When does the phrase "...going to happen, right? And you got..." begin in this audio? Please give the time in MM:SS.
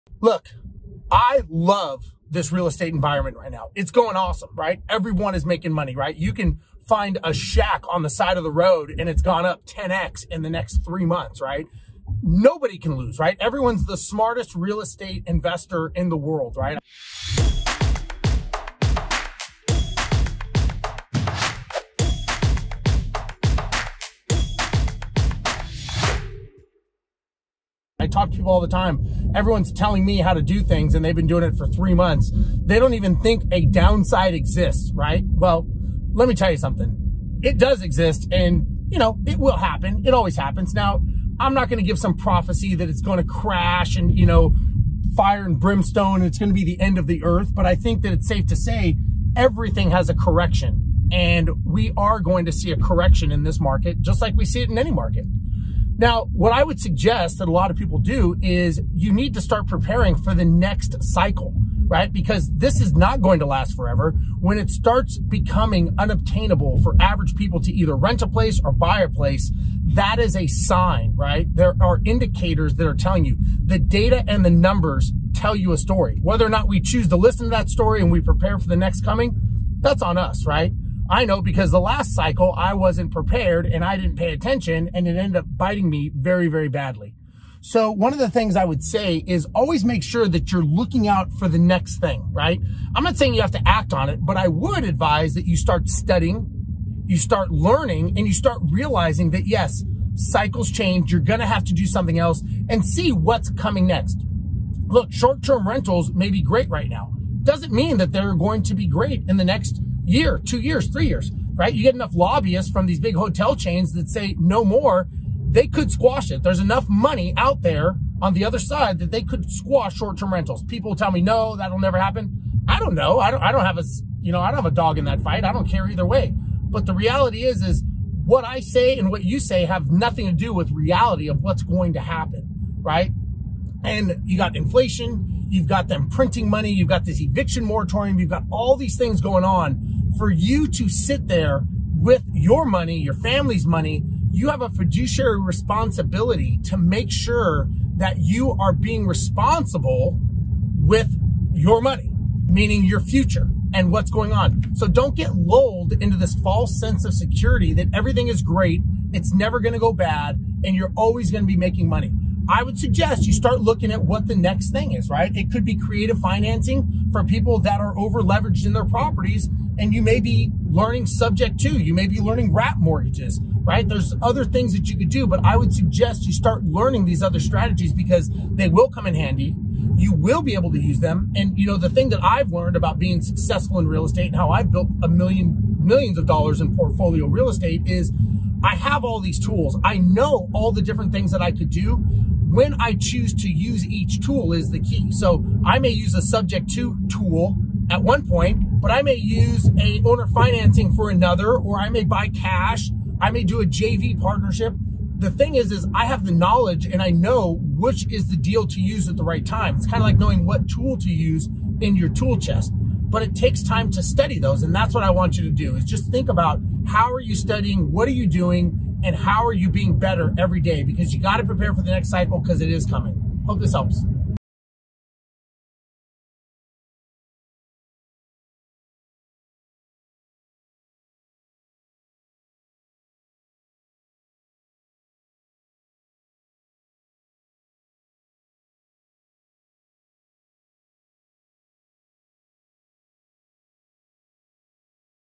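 02:11.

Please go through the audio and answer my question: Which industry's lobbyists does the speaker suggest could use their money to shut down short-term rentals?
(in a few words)
Big hotel chains.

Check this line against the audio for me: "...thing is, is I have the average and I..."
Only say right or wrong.
wrong.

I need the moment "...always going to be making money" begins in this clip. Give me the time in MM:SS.
02:40.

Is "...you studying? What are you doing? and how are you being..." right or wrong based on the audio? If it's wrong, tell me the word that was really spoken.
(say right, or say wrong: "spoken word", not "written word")
right.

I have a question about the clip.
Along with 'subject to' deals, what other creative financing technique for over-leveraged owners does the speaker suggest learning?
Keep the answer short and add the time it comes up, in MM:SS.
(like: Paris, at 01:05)
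Wrap mortgages, at 02:52.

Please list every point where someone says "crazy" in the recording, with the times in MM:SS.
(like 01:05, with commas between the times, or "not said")
not said.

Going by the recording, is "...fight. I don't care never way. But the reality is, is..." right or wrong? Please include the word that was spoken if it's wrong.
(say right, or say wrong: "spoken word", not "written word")
wrong: "either", not "never".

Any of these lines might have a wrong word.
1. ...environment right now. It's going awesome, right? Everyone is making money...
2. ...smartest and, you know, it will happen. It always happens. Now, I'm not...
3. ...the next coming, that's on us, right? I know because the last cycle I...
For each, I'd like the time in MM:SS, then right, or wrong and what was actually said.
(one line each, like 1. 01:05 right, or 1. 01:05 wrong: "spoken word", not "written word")
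1. 00:02 right
2. 00:37 wrong: "exist", not "smartest"
3. 01:18 right.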